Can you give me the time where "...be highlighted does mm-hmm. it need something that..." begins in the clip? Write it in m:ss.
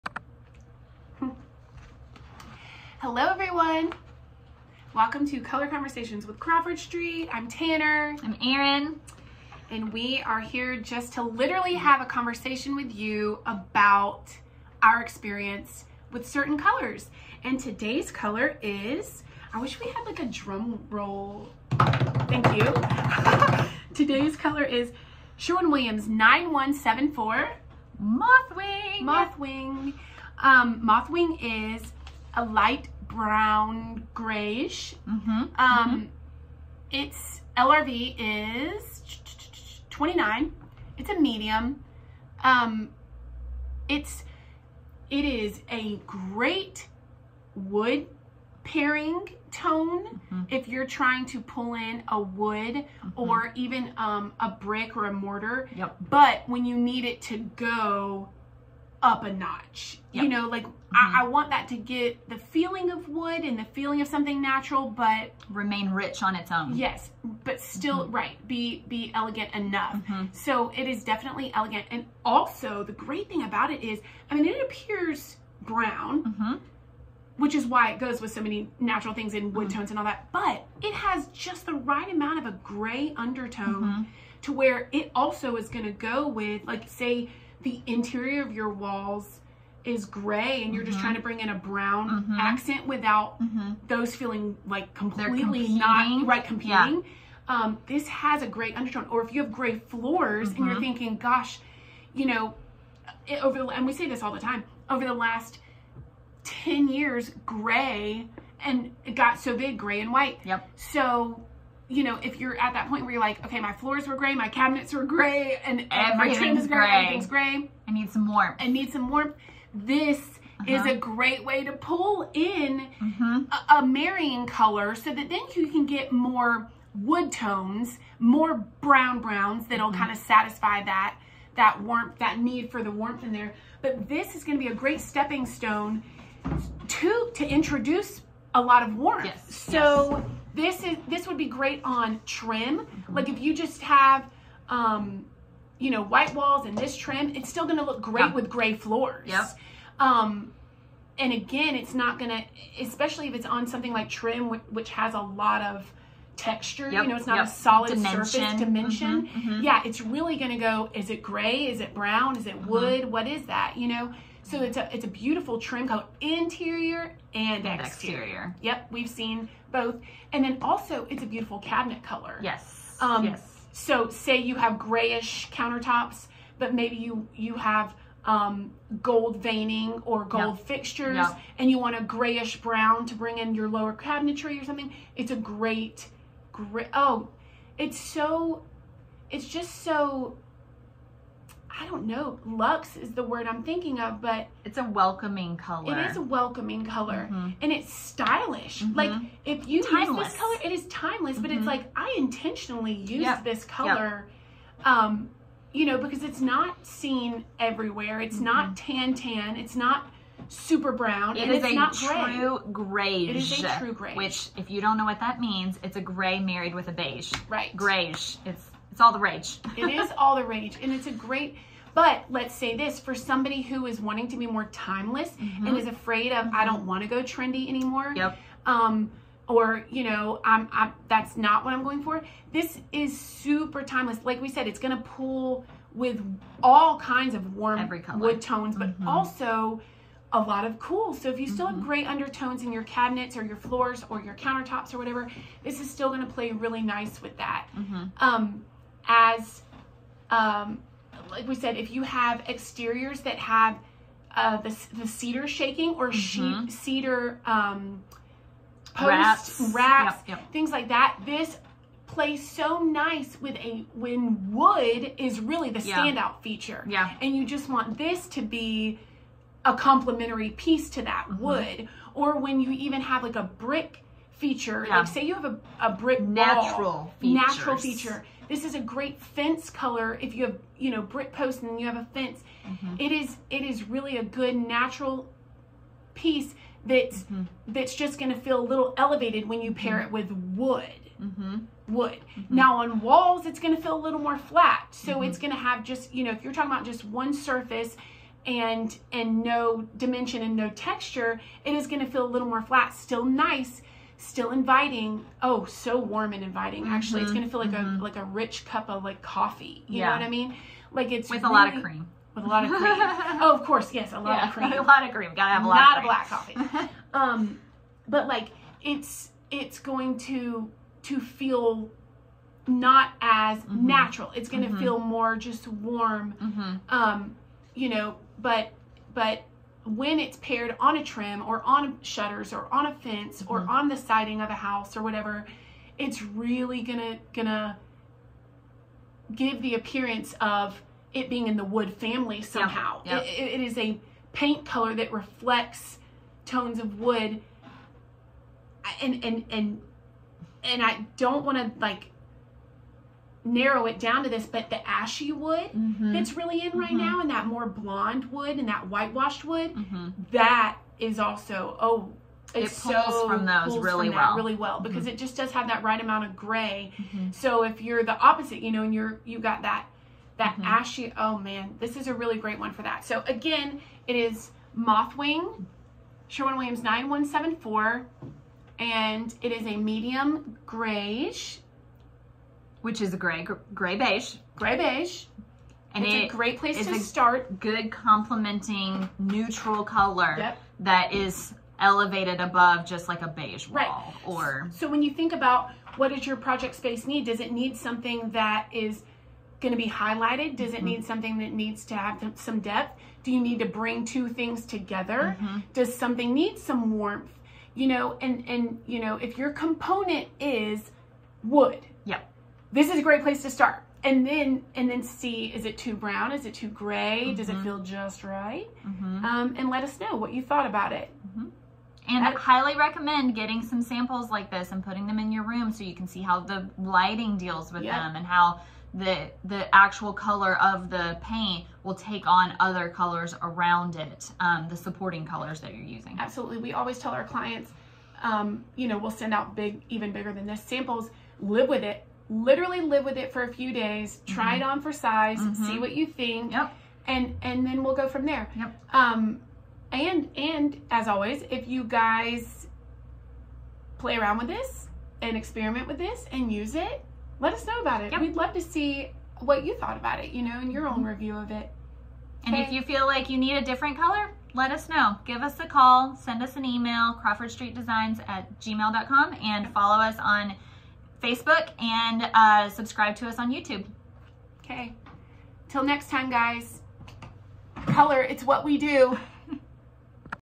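6:39.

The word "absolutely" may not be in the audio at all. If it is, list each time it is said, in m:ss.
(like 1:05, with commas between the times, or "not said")
7:16.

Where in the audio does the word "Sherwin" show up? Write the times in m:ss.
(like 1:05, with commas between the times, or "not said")
0:25, 6:16.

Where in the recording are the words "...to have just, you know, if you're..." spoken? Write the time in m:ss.
4:55.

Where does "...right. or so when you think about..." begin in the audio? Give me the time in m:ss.
6:33.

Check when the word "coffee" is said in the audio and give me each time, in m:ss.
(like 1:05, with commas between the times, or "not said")
5:09, 5:16.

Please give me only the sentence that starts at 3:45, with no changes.
and is afraid of, I don't want to go trendy anymore.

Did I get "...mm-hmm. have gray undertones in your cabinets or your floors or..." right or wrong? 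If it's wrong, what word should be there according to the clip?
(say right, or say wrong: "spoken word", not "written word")
right.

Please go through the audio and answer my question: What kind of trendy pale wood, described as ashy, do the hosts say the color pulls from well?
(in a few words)
whitewashed wood.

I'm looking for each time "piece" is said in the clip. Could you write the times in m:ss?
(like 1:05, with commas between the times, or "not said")
4:30, 4:46.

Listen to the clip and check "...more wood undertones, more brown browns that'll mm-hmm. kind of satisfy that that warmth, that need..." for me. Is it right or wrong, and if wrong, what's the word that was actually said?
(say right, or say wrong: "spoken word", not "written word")
wrong: "tones", not "undertones".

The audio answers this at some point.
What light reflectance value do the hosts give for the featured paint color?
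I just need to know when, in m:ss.
0:39.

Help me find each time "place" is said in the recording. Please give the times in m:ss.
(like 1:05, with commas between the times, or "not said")
6:26, 6:53.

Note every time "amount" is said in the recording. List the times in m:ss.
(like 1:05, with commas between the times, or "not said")
1:22, 6:06.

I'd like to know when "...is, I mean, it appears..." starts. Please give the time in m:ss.
1:13.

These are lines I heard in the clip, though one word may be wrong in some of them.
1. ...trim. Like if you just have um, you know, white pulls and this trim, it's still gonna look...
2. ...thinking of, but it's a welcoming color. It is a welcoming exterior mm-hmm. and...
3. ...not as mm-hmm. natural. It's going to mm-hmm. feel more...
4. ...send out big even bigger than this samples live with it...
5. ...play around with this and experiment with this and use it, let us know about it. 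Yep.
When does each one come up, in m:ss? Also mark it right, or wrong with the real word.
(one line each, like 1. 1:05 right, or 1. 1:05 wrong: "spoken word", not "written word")
1. 2:22 wrong: "walls", not "pulls"
2. 3:13 wrong: "color", not "exterior"
3. 5:22 right
4. 7:19 right
5. 7:33 right.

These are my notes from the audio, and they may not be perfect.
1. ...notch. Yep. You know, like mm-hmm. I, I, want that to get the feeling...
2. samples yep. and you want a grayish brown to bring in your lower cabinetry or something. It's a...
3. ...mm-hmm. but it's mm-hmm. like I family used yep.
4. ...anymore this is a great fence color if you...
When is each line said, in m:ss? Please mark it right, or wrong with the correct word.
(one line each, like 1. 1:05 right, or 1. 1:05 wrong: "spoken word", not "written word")
1. 0:59 right
2. 3:00 wrong: "fixtures", not "samples"
3. 3:21 wrong: "intentionally", not "family"
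4. 4:37 wrong: "feature", not "anymore".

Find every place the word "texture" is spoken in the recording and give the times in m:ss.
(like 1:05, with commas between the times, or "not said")
2:36, 5:00.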